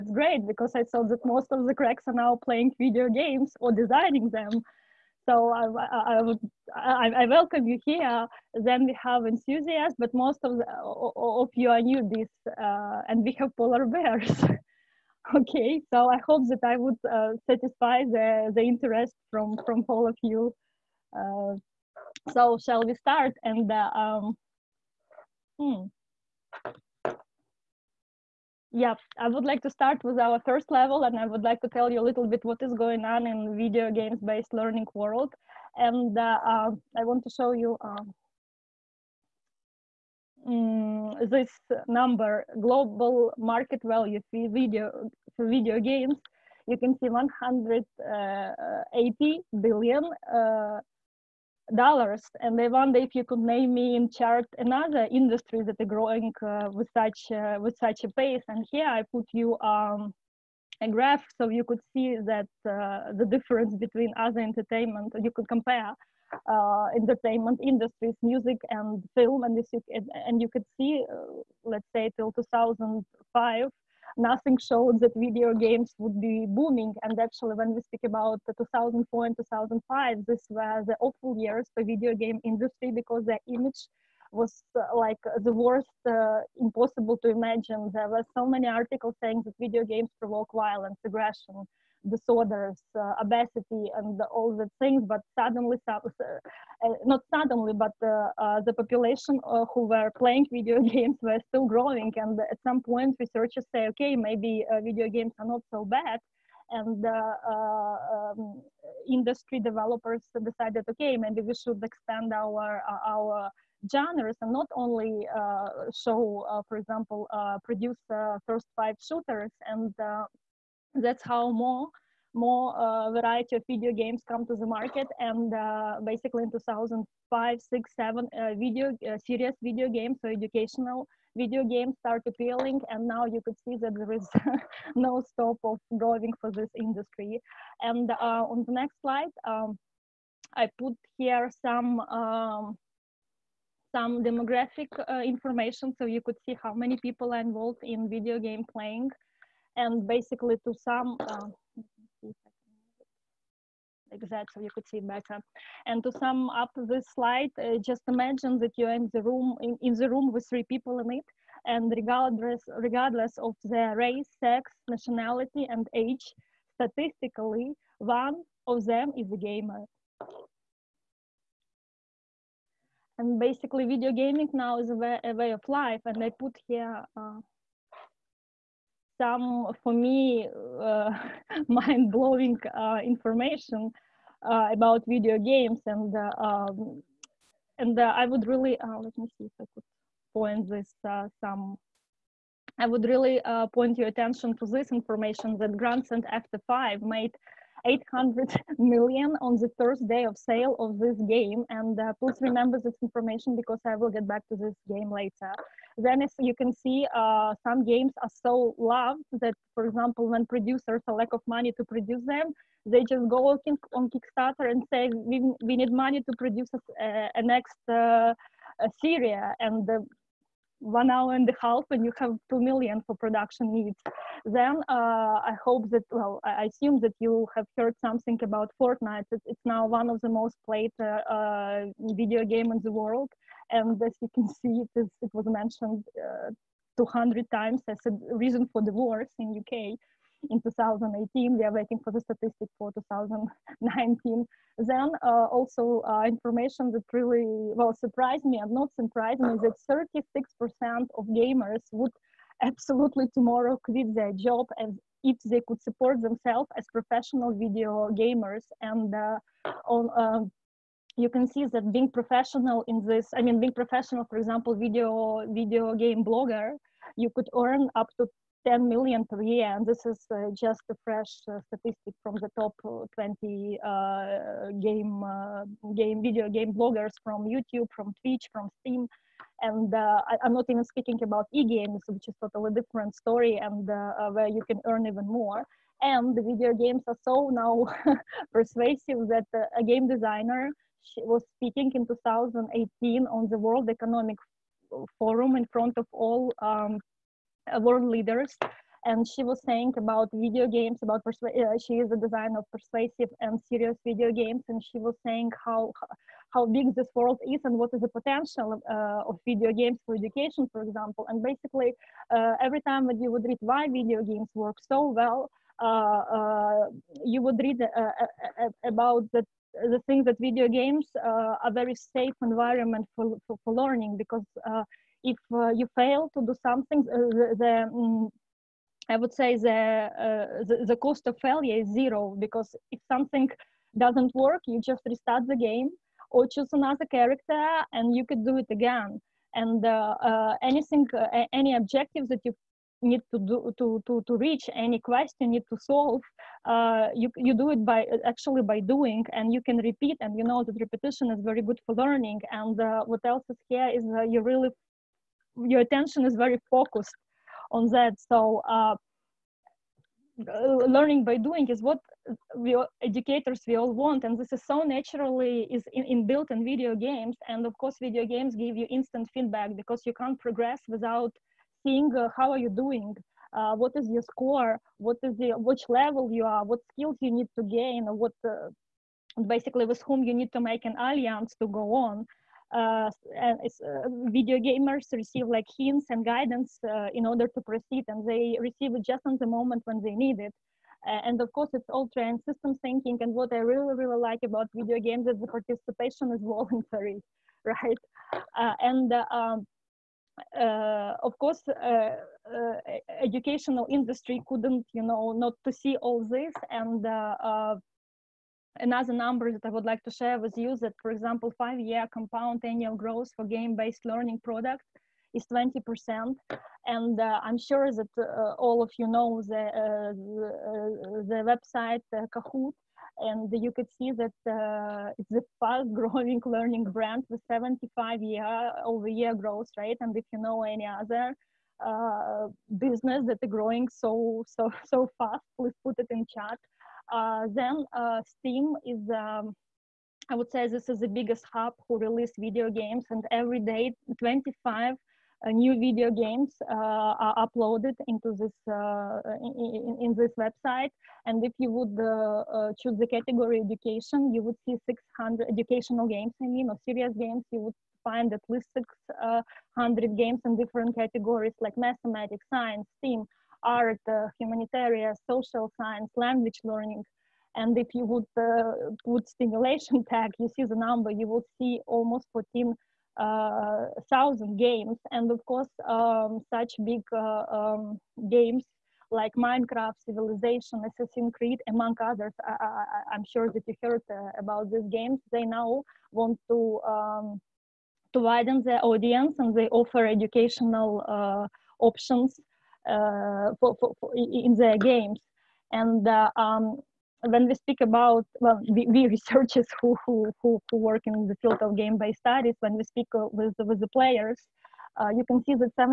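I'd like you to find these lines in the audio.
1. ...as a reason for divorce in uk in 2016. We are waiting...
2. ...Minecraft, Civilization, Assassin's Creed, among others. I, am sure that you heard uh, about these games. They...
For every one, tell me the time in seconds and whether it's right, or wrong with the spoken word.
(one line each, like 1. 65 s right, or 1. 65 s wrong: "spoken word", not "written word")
1. 237 s wrong: "2018", not "2016"
2. 479 s right.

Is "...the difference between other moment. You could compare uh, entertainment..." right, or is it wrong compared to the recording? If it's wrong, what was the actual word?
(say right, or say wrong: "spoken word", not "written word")
wrong: "entertainment", not "moment".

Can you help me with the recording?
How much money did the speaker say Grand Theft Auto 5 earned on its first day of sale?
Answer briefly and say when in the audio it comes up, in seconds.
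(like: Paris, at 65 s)
800 million, at 197 s.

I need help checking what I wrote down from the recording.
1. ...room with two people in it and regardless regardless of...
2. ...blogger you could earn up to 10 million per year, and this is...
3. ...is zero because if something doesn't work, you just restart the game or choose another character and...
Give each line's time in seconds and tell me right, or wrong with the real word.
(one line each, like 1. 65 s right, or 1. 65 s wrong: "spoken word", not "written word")
1. 160 s wrong: "three", not "two"
2. 266 s right
3. 331 s right.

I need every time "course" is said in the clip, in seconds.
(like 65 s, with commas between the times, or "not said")
367 s, 391 s, 401 s, 475 s.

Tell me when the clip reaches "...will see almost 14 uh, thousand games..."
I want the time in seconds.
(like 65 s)
471 s.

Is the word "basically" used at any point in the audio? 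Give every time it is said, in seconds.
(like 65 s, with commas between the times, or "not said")
126 s, 150 s, 173 s, 311 s, 379 s.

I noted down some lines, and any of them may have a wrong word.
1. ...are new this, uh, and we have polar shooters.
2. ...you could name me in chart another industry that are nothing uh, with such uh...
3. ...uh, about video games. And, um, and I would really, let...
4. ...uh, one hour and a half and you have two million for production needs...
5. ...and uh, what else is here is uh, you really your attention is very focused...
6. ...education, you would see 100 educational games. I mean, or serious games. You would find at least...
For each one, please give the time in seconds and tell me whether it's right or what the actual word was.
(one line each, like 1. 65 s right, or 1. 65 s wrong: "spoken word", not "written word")
1. 11 s wrong: "bears", not "shooters"
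2. 53 s wrong: "growing", not "nothing"
3. 184 s right
4. 219 s right
5. 352 s right
6. 453 s wrong: "600", not "100".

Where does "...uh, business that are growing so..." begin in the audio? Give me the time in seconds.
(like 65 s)
431 s.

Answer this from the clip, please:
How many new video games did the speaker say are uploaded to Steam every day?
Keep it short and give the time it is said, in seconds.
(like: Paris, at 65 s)
25, at 444 s.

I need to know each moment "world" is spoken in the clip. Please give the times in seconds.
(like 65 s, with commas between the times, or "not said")
34 s, 232 s, 293 s, 297 s, 307 s.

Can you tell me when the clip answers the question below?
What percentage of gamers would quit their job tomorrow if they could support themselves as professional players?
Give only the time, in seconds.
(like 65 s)
250 s.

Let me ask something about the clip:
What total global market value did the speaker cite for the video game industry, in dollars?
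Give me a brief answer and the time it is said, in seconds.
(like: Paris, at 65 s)
180 billion, at 47 s.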